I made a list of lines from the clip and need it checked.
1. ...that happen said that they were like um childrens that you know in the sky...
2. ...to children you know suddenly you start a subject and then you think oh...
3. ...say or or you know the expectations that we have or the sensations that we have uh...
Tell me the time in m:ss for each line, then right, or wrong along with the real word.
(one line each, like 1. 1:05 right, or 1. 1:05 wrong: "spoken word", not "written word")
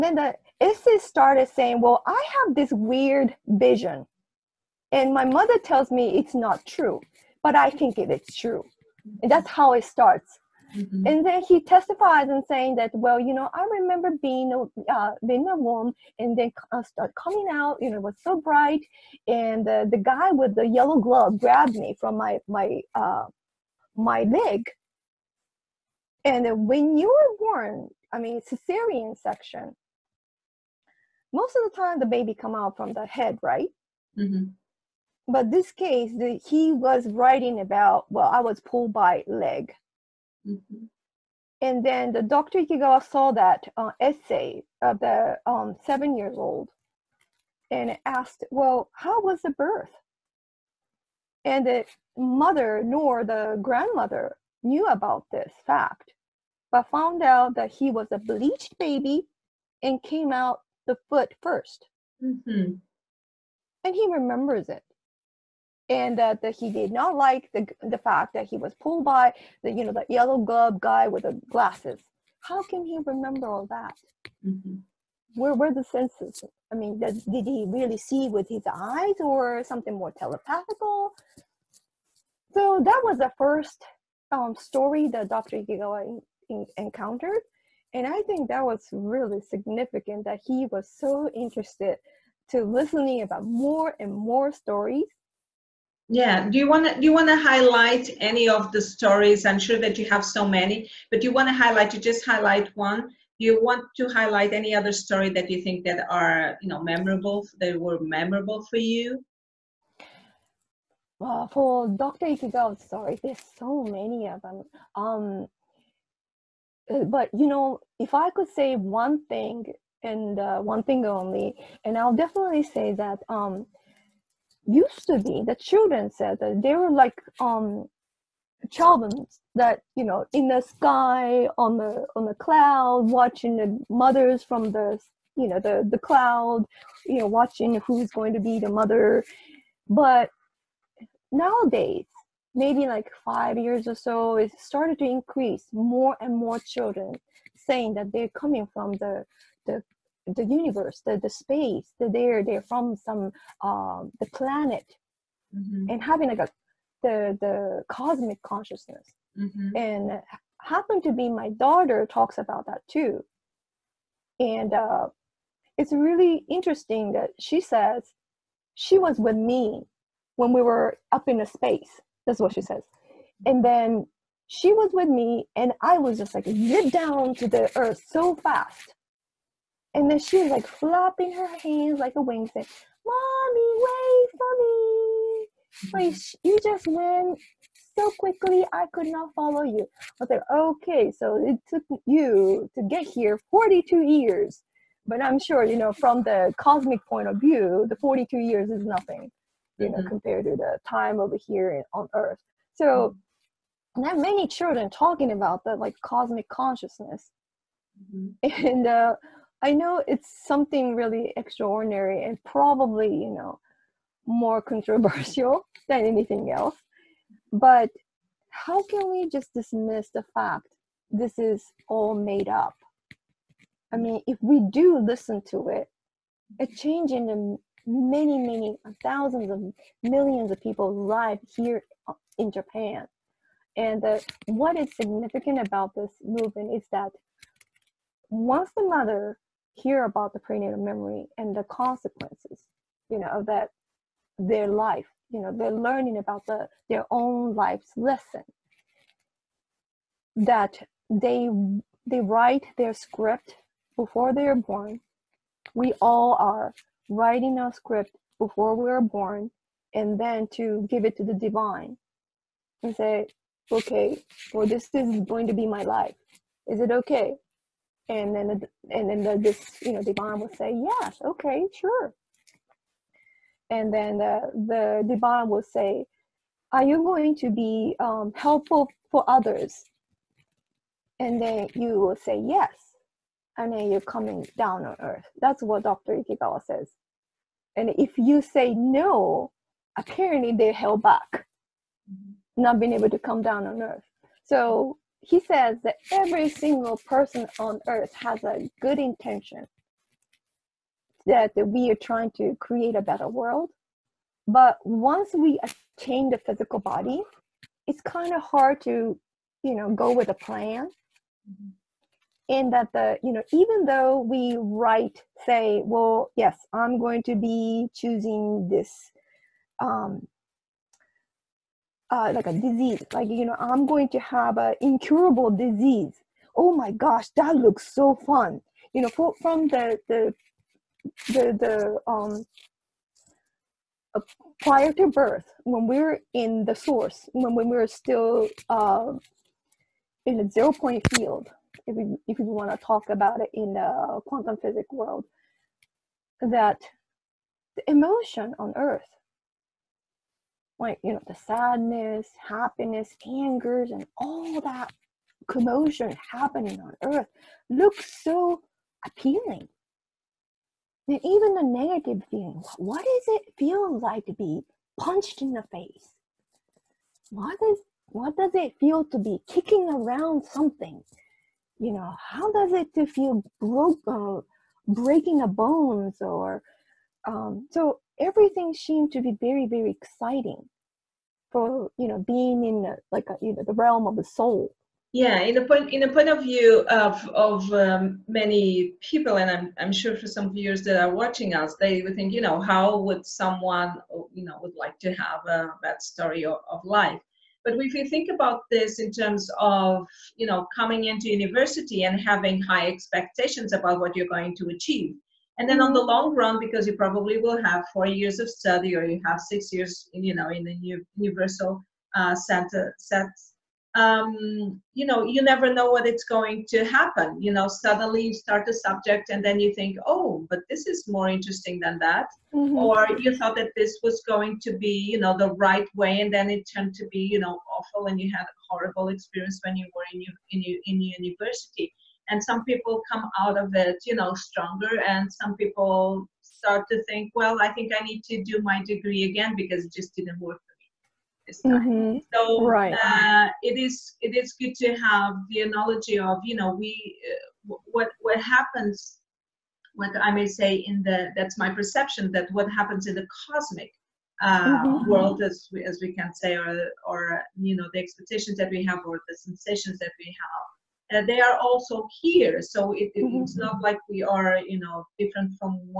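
1. 2:05 wrong: "children", not "happen"
2. 6:56 wrong: "happen", not "children"
3. 7:36 right.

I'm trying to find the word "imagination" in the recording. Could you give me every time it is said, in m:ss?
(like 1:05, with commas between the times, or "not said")
not said.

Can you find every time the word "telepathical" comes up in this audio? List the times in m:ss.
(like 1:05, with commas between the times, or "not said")
1:20.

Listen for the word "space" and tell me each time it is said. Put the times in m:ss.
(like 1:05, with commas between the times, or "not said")
2:31, 2:51.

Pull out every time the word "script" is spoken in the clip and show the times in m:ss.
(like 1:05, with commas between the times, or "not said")
4:12, 4:17.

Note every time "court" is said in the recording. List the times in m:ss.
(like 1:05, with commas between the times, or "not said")
not said.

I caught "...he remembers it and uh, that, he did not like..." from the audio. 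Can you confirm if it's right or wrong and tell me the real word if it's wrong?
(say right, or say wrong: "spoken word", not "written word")
right.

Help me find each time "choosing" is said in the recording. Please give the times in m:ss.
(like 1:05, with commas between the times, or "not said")
5:17.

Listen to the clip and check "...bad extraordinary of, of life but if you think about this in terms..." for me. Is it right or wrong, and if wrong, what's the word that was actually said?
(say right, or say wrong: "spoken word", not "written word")
wrong: "story", not "extraordinary".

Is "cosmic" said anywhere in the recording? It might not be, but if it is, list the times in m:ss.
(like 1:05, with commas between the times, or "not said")
2:37, 3:16, 3:26, 7:33.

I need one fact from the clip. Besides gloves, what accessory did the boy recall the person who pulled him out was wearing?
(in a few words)
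Glasses.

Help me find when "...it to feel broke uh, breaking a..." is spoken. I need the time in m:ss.
6:12.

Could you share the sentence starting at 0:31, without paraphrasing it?
Most of the time, the baby come out from the head, right?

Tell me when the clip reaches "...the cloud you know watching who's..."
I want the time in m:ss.
2:15.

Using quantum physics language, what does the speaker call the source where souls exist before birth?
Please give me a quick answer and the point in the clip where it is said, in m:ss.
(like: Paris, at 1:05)
Zero point field, at 5:40.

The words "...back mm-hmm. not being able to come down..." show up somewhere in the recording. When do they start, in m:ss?
4:51.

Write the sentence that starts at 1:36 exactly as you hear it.
Do you want to you want to highlight any of the stories?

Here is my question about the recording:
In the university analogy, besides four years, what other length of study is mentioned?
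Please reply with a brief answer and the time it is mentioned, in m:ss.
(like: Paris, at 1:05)
6 years, at 6:49.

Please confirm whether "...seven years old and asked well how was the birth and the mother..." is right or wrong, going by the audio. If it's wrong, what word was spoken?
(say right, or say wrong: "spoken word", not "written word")
right.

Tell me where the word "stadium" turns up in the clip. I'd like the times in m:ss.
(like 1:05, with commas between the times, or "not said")
not said.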